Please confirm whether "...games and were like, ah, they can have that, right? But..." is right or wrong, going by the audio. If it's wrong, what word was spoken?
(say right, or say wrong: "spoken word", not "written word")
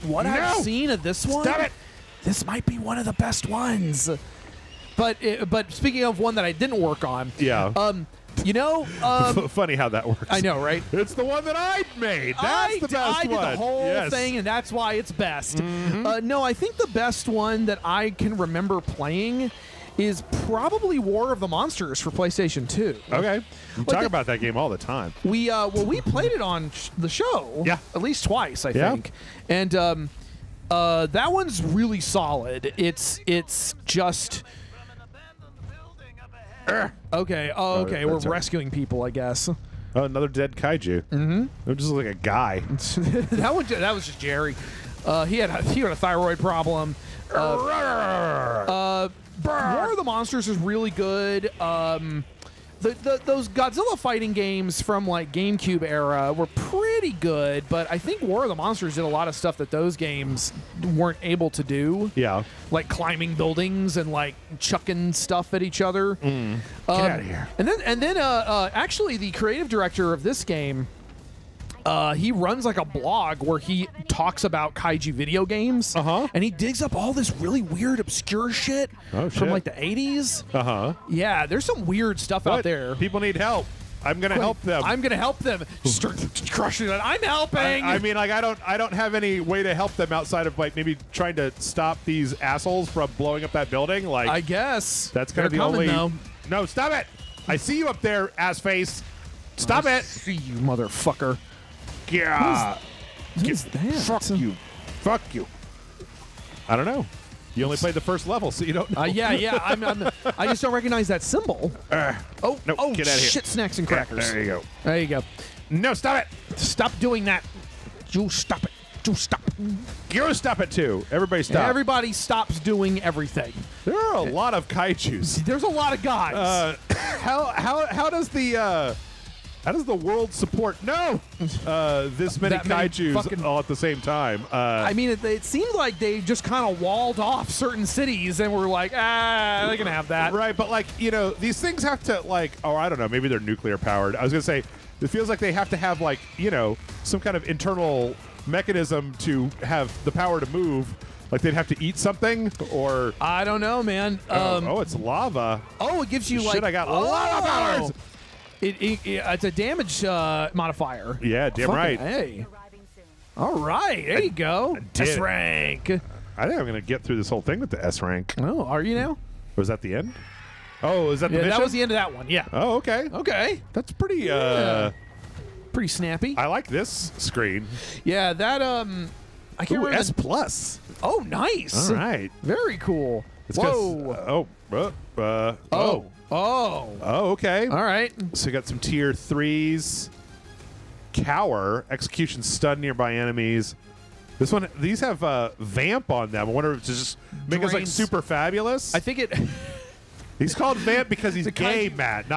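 wrong: "cities", not "games".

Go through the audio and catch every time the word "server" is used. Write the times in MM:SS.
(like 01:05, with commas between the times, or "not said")
not said.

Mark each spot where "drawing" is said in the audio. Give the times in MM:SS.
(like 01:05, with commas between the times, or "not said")
not said.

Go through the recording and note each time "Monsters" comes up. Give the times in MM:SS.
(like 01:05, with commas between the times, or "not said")
00:21, 00:50, 00:58.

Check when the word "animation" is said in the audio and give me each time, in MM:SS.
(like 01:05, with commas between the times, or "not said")
not said.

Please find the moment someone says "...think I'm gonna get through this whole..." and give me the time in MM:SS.
02:46.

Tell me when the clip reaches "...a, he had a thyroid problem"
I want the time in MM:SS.
00:45.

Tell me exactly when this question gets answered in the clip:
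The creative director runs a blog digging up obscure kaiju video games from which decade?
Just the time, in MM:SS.
01:19.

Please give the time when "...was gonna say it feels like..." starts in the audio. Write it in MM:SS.
02:24.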